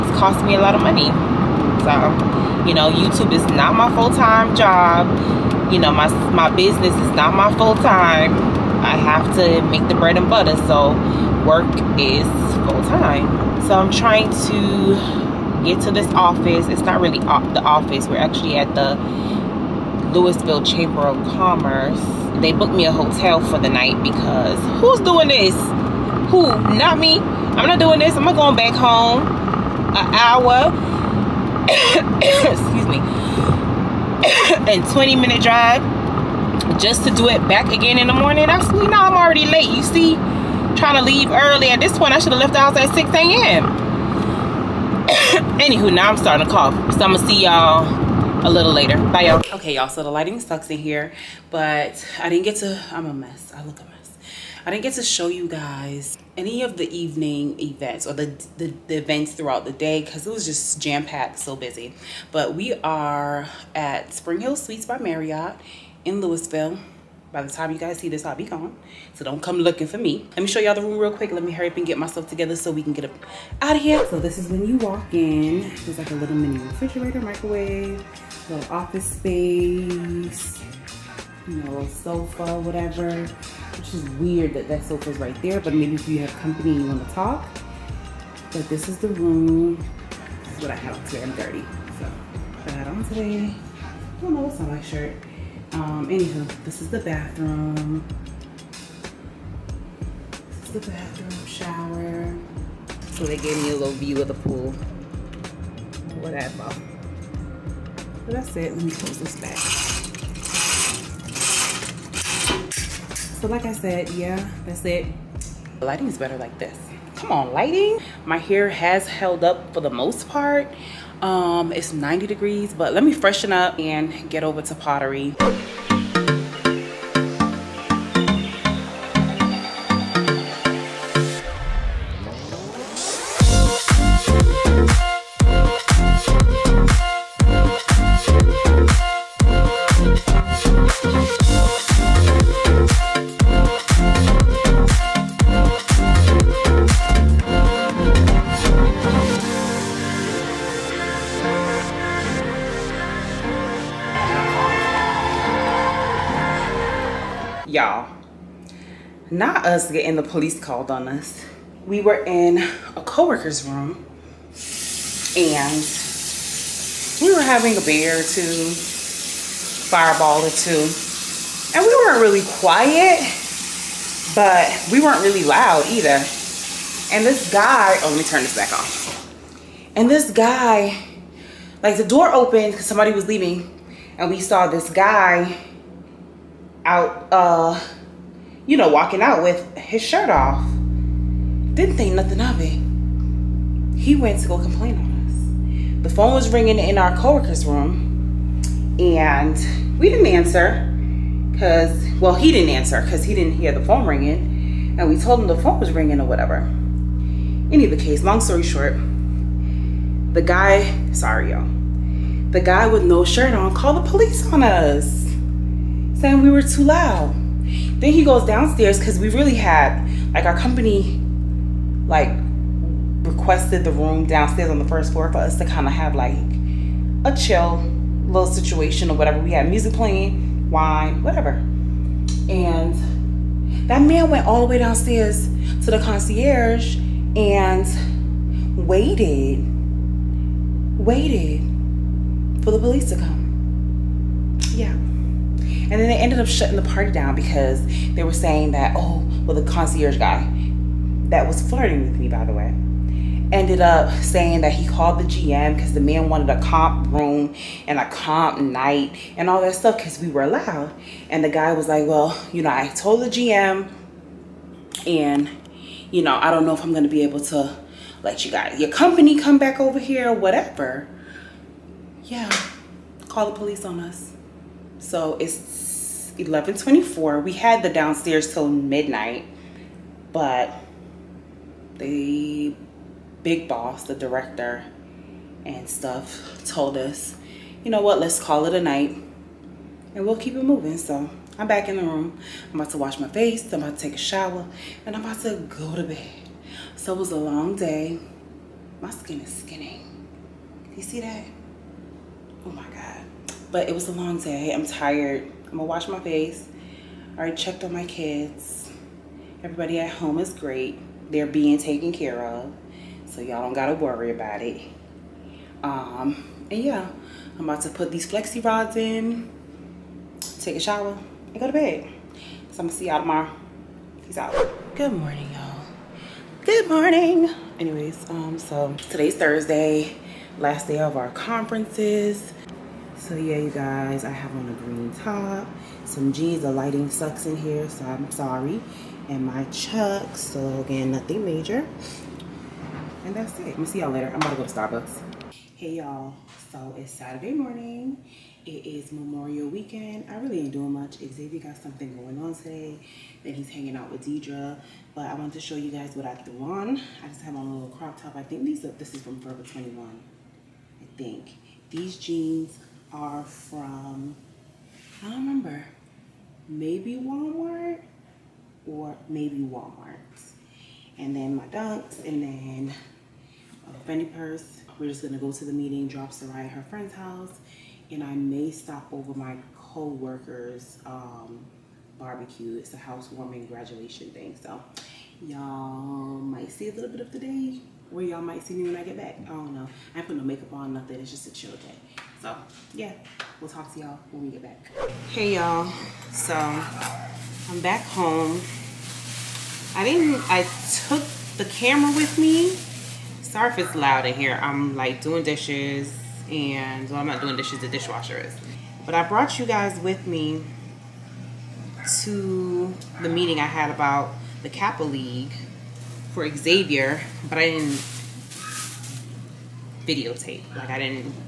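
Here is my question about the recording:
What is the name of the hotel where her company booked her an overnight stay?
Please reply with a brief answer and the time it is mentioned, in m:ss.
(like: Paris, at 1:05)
Spring Hill Suites, at 1:04.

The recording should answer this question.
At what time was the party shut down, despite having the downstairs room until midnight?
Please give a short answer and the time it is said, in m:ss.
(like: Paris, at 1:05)
11:24, at 4:36.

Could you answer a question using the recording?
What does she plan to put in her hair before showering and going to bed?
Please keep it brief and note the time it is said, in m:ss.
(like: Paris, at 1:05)
flexi rods, at 5:18.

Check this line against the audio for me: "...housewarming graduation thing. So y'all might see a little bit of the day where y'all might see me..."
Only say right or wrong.
right.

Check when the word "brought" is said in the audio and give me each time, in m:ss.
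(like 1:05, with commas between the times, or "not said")
6:49.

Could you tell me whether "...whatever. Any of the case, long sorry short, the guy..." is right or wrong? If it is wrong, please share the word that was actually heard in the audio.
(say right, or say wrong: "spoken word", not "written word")
wrong: "story", not "sorry".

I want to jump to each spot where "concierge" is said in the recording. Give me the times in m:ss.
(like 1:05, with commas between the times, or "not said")
3:55, 4:09.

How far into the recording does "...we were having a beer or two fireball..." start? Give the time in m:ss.
2:47.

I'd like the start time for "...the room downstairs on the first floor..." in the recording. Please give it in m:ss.
3:43.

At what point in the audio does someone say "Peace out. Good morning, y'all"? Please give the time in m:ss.
5:24.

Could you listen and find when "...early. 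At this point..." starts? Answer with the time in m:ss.
0:41.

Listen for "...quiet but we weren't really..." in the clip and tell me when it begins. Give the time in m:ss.
2:52.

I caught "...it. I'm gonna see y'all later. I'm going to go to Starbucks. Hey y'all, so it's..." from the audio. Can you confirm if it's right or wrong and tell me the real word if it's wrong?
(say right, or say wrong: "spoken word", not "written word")
right.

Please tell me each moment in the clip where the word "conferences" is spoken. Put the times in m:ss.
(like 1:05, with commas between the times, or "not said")
5:31.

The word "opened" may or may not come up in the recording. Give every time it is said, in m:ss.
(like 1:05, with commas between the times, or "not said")
3:02.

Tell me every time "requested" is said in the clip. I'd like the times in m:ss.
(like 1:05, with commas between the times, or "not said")
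3:43.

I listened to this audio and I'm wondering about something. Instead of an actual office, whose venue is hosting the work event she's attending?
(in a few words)
Lewisville Chamber of Commerce.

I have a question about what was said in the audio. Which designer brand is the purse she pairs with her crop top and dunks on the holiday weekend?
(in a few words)
Fendi.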